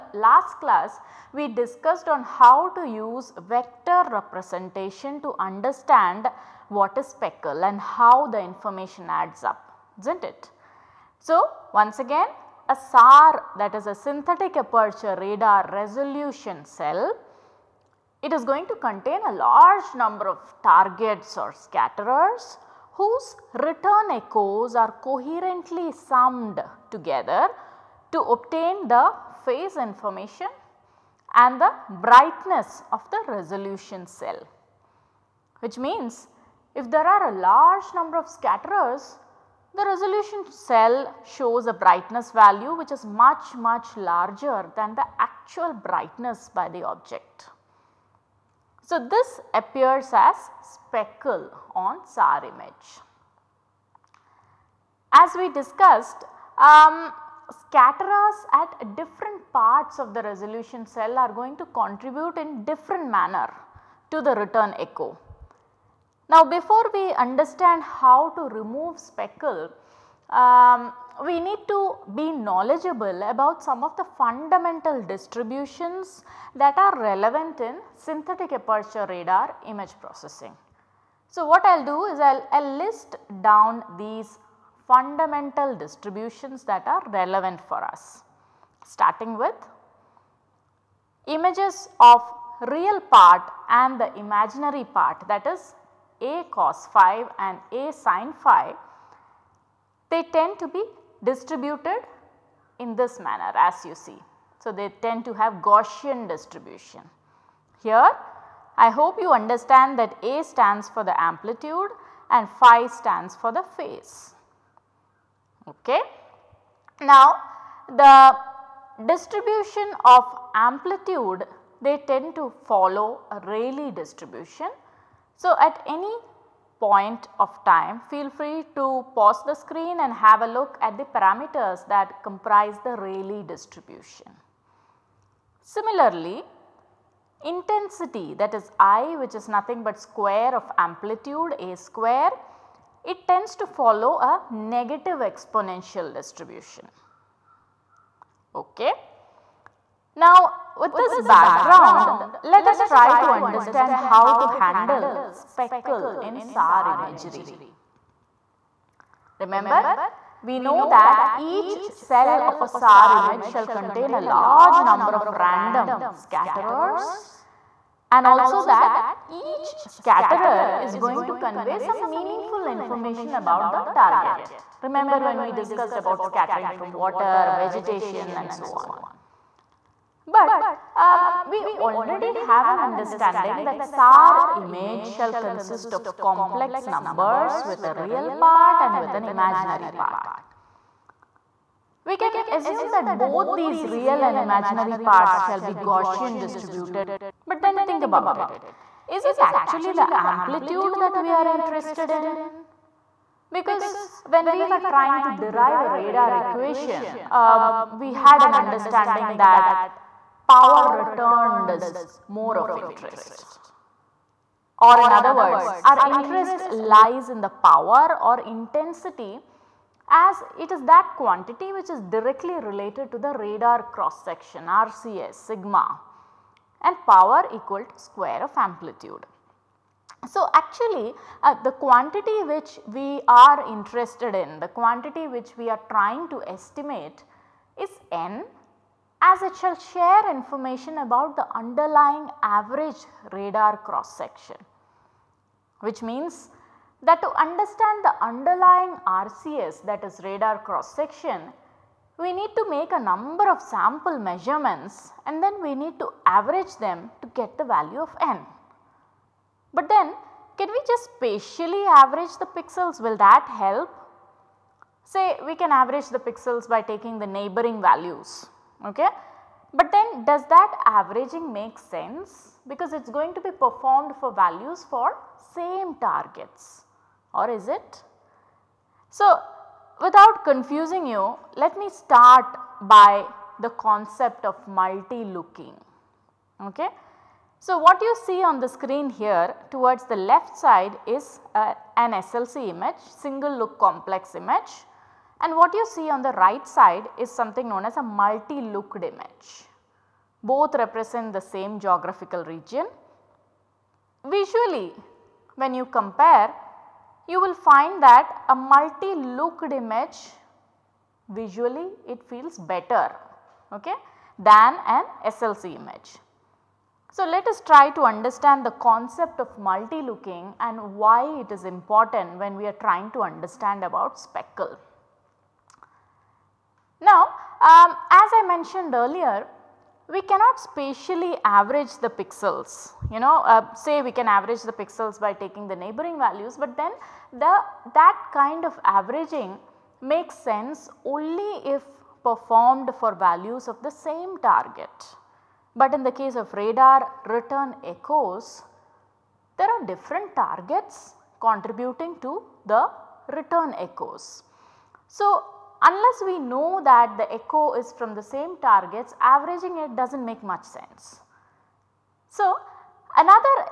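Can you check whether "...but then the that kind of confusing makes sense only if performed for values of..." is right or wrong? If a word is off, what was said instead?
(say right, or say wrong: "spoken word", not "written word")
wrong: "averaging", not "confusing".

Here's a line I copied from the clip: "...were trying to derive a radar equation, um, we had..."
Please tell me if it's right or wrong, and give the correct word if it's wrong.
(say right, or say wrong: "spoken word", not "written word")
right.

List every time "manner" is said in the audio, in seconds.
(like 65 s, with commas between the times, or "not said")
63 s, 103 s.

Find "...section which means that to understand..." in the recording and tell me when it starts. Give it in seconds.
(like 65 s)
244 s.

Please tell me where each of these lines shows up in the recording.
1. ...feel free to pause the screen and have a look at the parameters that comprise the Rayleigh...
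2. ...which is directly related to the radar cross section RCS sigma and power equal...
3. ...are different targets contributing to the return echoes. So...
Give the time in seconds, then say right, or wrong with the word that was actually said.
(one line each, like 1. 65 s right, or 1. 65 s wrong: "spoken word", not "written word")
1. 128 s right
2. 221 s right
3. 349 s right.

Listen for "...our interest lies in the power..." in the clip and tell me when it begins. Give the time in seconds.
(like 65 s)
215 s.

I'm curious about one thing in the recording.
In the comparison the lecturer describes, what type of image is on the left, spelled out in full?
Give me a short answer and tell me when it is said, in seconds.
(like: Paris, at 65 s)
Single look complex, at 293 s.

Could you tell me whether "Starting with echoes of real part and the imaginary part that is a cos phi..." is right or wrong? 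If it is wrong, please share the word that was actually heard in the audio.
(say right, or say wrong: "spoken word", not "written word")
wrong: "images", not "echoes".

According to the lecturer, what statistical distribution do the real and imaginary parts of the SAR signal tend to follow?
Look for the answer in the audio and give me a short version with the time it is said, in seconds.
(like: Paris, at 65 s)
Gaussian distribution, at 105 s.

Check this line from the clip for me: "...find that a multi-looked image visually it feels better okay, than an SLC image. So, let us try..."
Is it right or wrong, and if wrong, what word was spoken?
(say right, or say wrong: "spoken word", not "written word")
right.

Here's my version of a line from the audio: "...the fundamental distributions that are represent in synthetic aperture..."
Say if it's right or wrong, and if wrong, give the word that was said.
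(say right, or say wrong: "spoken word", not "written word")
wrong: "relevant", not "represent".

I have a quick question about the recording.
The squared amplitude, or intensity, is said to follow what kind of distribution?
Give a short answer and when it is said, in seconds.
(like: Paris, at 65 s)
Negative exponential, at 144 s.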